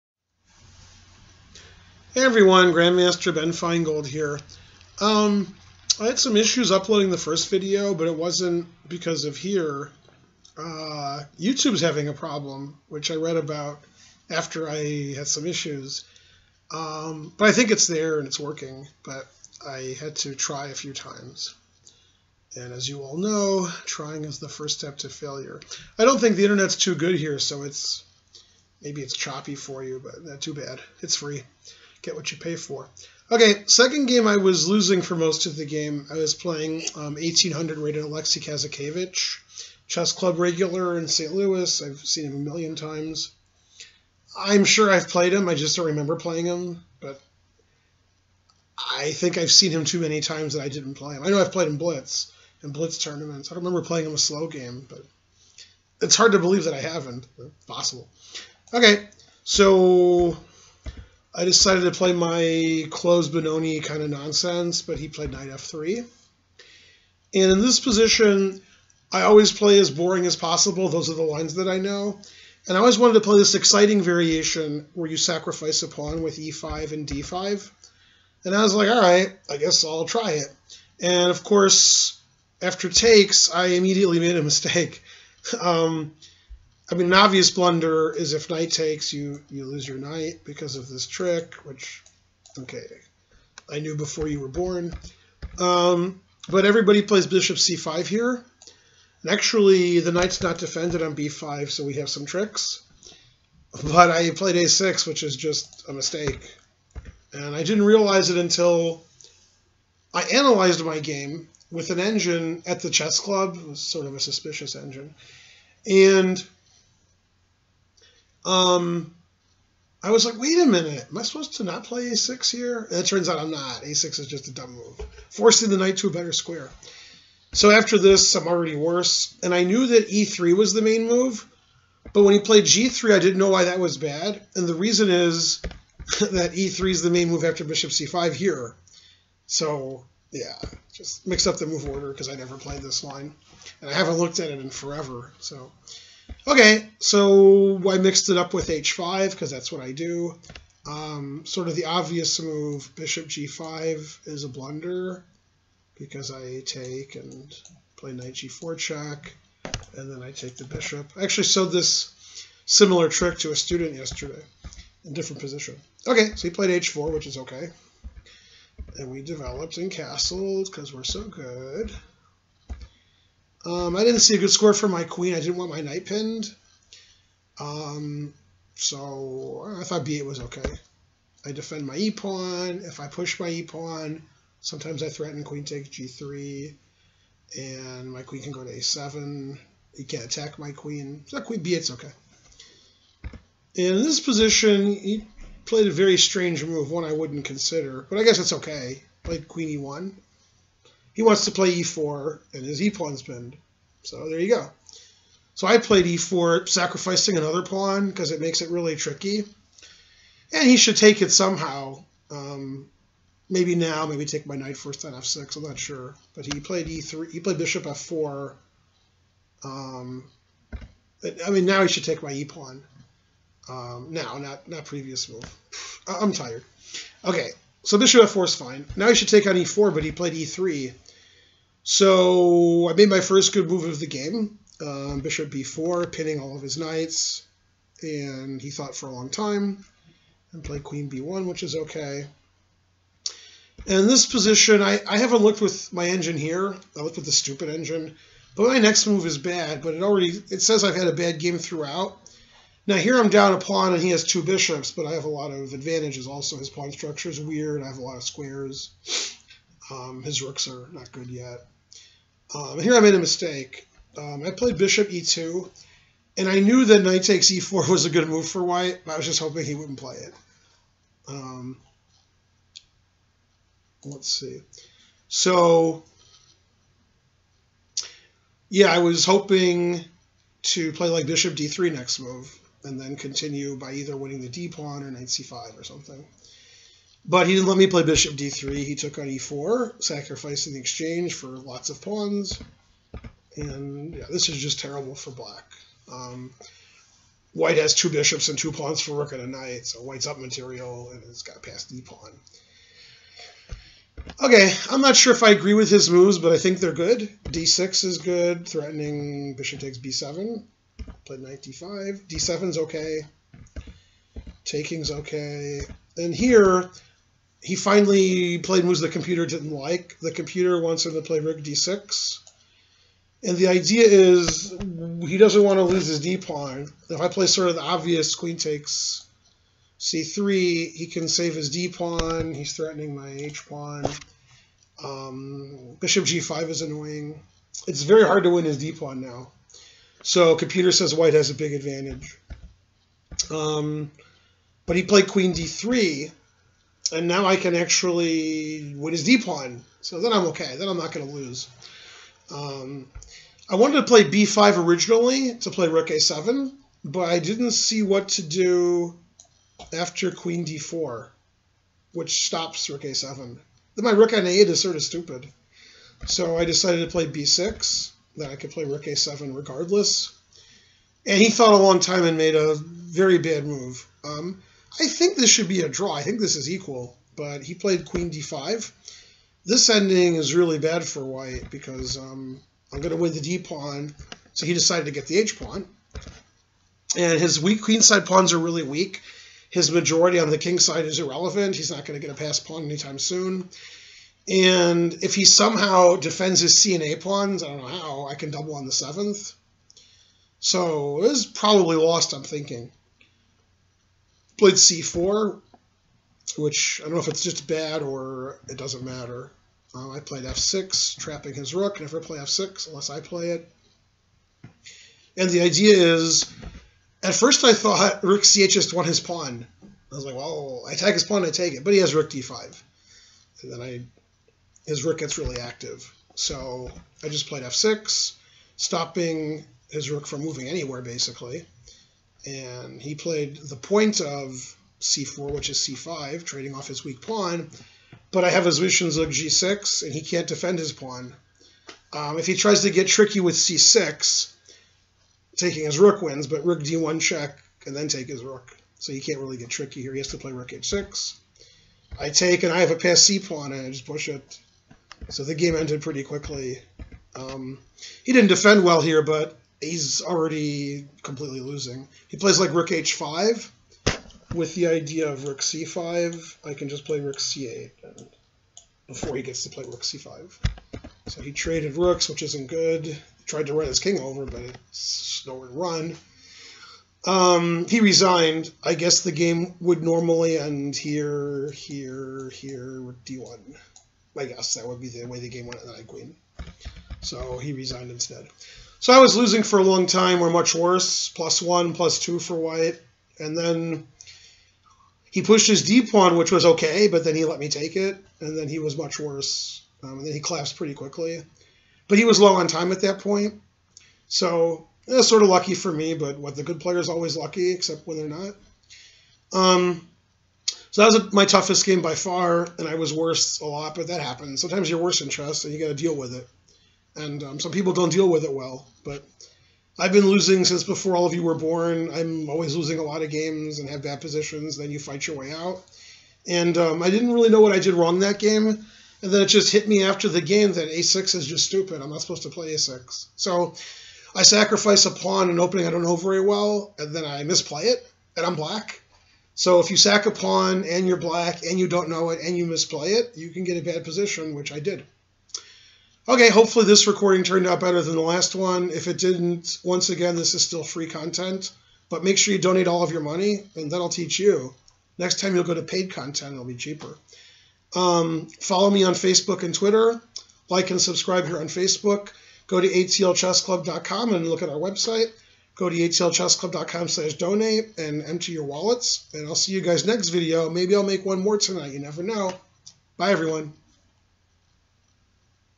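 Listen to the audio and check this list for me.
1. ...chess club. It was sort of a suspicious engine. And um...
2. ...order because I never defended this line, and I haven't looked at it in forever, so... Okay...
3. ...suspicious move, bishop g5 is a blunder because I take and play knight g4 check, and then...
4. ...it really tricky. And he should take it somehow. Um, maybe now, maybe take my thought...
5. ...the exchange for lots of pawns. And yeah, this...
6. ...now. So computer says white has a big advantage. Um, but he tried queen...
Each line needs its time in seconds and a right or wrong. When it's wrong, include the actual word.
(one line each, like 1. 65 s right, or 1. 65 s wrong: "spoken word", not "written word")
1. 112 s right
2. 141 s wrong: "played", not "defended"
3. 151 s wrong: "obvious", not "suspicious"
4. 208 s wrong: "knight", not "thought"
5. 290 s right
6. 339 s wrong: "played", not "tried".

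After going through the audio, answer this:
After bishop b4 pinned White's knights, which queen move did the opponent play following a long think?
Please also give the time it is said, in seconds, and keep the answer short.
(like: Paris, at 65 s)
Queen b1, at 240 s.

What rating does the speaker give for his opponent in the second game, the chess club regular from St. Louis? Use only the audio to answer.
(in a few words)
1800.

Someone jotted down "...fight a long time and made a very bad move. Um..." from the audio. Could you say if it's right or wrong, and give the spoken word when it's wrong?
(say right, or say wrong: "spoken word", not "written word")
wrong: "thought", not "fight".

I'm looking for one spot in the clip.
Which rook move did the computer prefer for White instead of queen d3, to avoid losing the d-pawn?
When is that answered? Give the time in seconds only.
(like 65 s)
321 s.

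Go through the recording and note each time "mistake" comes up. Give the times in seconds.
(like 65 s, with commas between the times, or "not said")
84 s, 105 s, 263 s.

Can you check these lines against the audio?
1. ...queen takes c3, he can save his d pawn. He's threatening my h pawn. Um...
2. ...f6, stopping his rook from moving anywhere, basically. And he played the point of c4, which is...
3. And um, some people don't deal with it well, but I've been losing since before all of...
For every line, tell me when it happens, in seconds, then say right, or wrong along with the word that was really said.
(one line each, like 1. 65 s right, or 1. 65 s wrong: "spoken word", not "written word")
1. 328 s right
2. 427 s right
3. 517 s right.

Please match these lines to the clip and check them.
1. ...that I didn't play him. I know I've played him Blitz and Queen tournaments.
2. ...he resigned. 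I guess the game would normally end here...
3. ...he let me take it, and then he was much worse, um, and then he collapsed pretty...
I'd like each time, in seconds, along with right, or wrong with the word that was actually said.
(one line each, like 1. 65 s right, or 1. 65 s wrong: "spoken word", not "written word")
1. 50 s wrong: "Blitz", not "Queen"
2. 477 s right
3. 497 s right.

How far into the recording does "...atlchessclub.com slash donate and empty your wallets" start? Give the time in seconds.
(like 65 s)
565 s.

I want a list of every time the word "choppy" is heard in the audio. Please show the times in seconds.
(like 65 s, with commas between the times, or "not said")
29 s.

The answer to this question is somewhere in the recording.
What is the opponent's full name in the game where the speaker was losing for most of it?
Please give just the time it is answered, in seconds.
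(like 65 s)
38 s.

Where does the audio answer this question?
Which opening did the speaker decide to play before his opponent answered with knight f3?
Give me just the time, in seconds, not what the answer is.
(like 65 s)
62 s.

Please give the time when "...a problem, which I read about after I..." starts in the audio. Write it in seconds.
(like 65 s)
12 s.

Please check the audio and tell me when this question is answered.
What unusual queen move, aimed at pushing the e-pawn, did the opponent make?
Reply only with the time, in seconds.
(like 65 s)
199 s.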